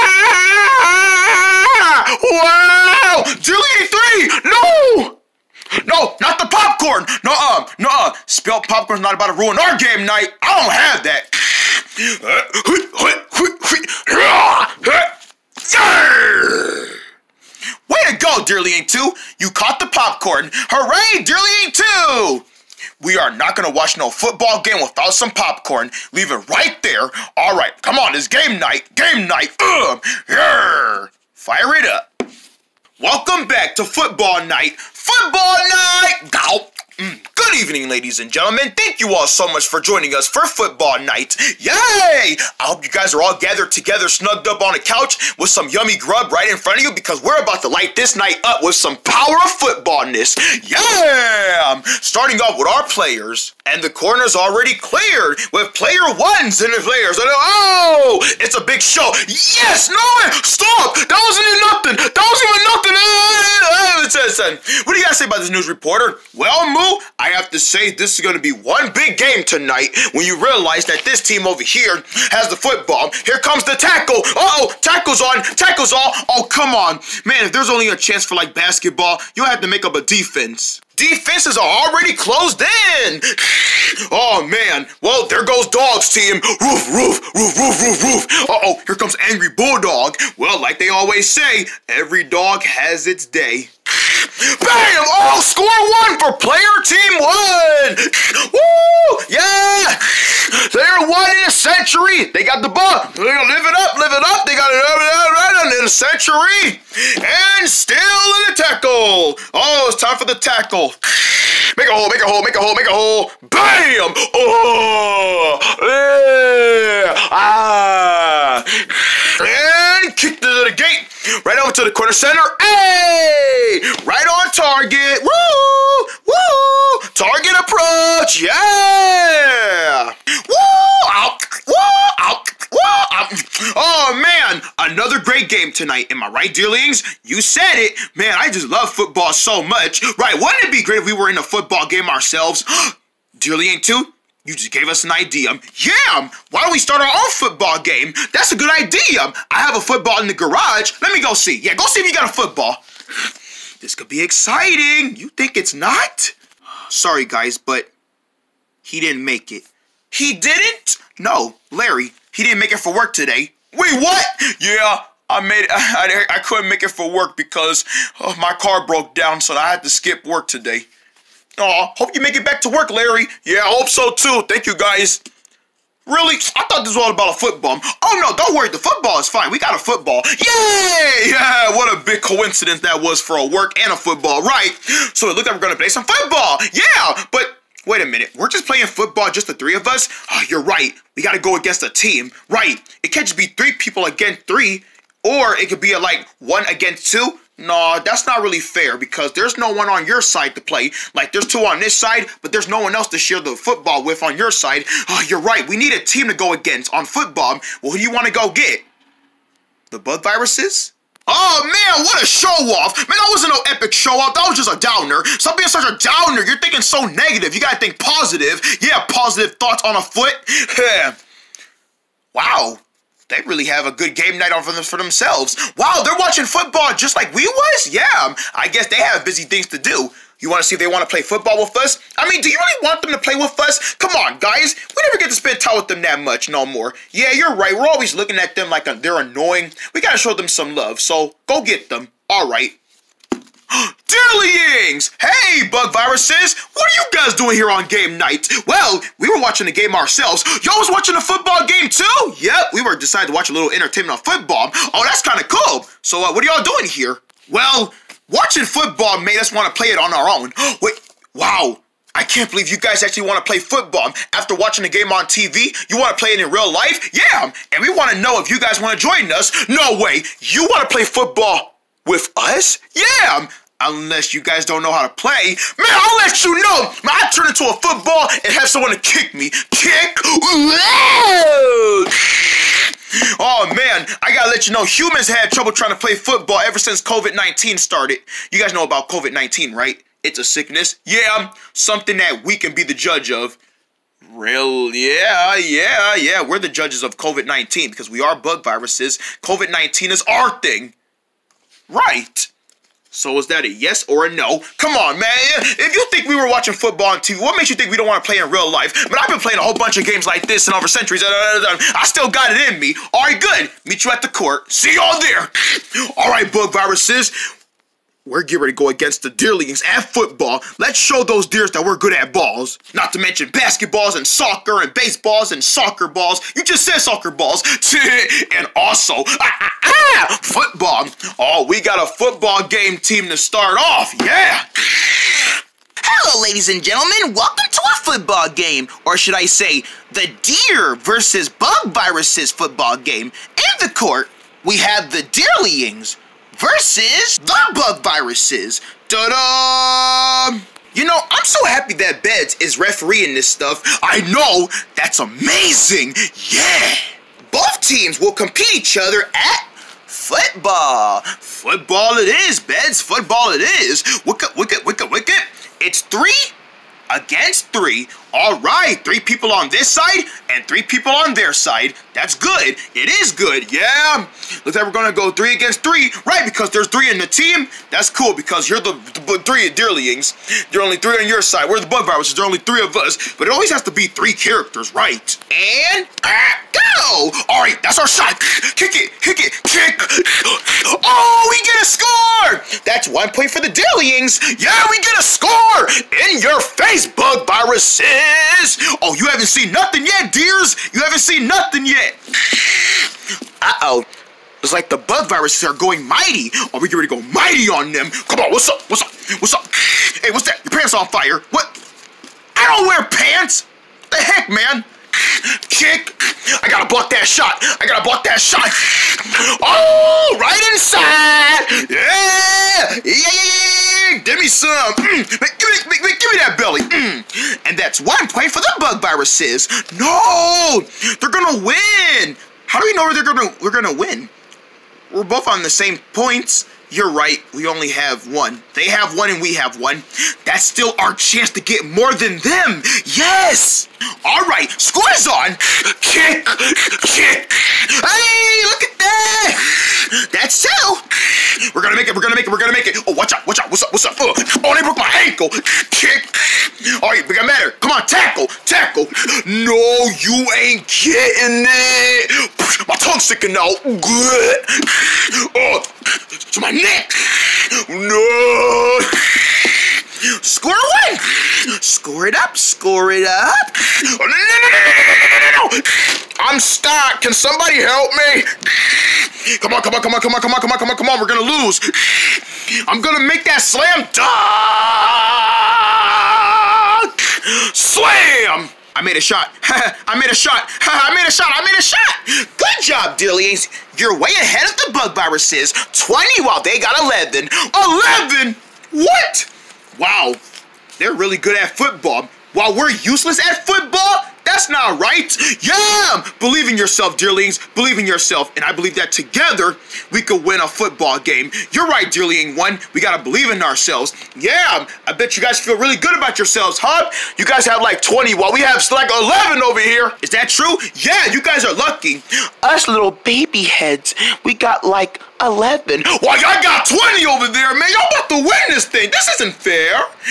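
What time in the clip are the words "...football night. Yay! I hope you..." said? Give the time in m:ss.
0:40.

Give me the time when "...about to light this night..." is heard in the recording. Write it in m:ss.
0:47.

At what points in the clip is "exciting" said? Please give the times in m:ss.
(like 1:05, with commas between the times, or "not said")
2:34.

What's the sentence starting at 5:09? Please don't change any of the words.
But I've been playing a whole bunch of games like this and over centuries.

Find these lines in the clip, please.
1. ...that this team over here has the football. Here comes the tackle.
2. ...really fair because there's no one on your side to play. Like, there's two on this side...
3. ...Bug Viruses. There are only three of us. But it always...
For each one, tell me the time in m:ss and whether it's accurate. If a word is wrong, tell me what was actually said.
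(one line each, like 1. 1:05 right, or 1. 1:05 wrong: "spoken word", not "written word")
1. 1:10 right
2. 3:18 right
3. 6:21 right.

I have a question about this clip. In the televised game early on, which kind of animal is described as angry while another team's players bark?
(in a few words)
Bulldog.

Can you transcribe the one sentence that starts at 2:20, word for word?
Right, wouldn't it be great if we were in a football game ourselves?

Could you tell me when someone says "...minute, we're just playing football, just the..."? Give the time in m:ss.
3:08.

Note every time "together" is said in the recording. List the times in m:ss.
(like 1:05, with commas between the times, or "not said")
0:43, 8:29.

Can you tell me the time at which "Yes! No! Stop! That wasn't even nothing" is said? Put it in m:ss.
0:59.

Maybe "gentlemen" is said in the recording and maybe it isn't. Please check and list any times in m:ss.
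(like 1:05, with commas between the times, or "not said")
0:38, 5:36.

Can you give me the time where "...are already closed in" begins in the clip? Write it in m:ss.
1:21.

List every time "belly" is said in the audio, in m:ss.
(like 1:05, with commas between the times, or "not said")
7:06.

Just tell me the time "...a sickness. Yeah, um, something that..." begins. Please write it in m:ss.
4:50.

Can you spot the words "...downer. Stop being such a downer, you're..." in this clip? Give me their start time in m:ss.
3:34.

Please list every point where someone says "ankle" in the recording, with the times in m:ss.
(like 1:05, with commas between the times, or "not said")
7:35.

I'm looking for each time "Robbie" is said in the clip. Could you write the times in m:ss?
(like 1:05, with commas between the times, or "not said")
not said.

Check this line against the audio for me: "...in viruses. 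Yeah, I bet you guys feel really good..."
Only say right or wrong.
wrong.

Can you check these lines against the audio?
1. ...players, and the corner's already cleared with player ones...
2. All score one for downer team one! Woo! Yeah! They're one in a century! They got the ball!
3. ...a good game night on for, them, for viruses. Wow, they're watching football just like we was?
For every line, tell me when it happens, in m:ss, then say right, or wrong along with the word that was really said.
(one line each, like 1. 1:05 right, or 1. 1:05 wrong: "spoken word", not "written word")
1. 0:52 right
2. 1:35 wrong: "player", not "downer"
3. 3:43 wrong: "themselves", not "viruses".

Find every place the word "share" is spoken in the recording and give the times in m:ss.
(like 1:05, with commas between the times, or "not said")
3:23.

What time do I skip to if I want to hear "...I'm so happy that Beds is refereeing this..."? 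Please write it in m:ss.
5:51.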